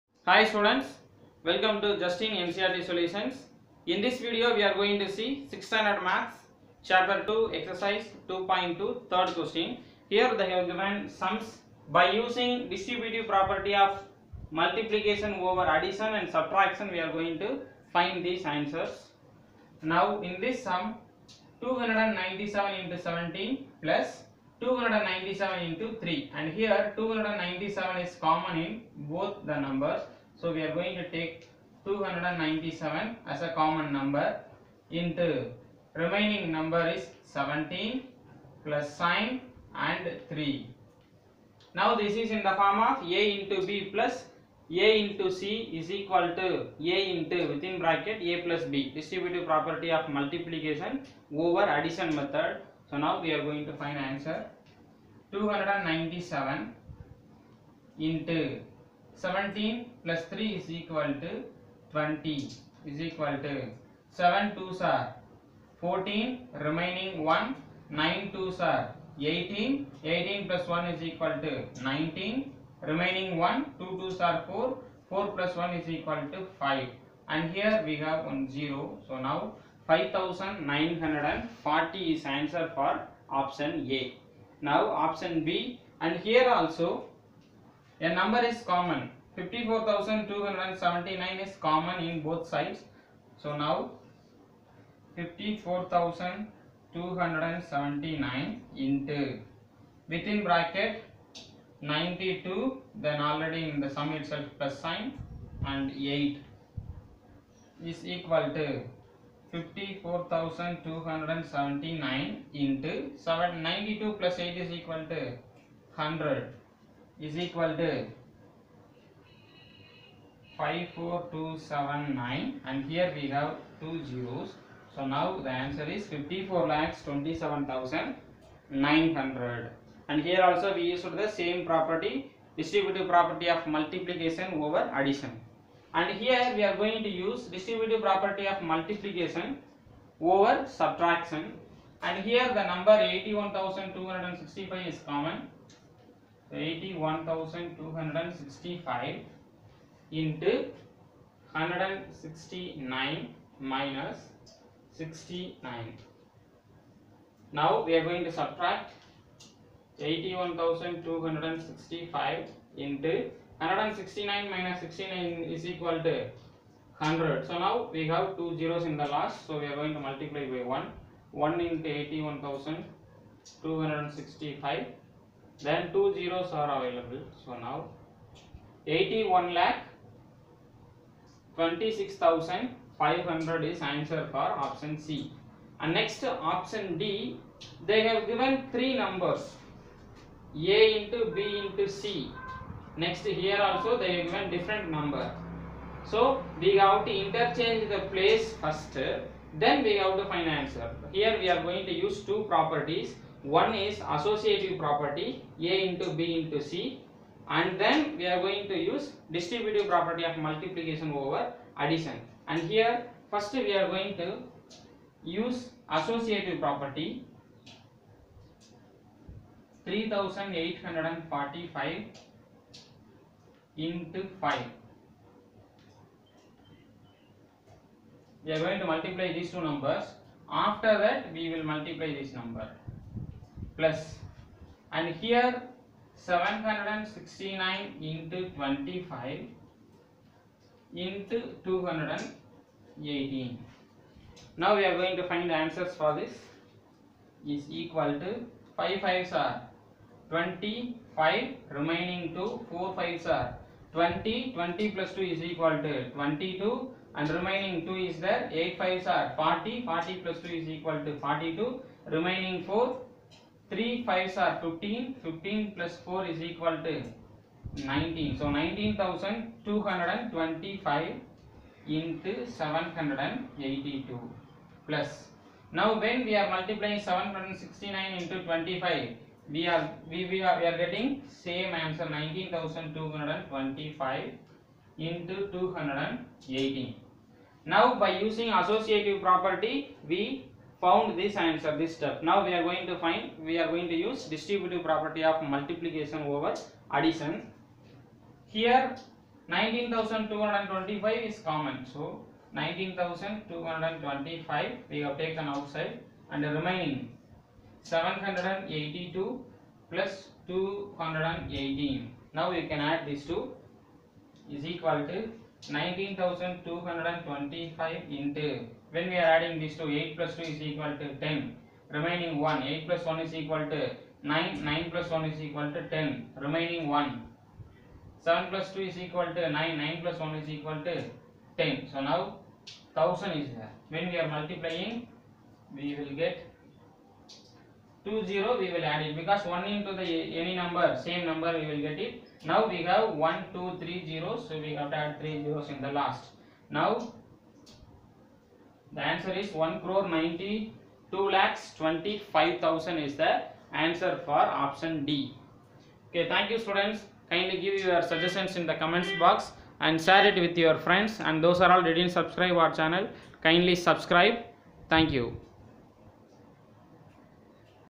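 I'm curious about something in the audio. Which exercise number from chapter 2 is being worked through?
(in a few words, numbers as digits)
2.2.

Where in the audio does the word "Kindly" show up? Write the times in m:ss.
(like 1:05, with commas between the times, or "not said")
5:57, 6:03.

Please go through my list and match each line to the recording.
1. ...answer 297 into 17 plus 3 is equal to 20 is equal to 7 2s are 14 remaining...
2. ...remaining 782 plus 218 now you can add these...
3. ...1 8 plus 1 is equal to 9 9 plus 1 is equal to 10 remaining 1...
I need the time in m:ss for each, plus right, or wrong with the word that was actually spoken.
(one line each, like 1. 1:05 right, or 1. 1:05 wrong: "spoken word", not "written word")
1. 0:53 right
2. 5:06 right
3. 5:22 right.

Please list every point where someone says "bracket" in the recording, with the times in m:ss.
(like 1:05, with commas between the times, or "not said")
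0:47, 1:40.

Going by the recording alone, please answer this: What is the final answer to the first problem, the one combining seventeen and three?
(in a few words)
5940.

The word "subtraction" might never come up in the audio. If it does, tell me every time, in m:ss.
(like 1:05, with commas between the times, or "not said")
0:16, 2:20.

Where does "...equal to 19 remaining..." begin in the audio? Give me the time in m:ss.
1:11.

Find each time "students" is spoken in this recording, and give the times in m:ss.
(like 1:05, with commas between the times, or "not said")
0:00, 5:56.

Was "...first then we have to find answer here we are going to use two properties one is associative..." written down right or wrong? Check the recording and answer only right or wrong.
right.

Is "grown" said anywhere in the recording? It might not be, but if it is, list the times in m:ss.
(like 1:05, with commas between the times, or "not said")
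not said.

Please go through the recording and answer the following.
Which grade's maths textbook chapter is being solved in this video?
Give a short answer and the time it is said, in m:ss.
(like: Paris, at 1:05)
6th standard, at 0:05.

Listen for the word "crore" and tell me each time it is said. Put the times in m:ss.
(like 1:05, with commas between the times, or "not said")
5:49.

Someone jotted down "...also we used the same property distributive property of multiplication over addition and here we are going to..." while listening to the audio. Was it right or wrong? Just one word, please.
right.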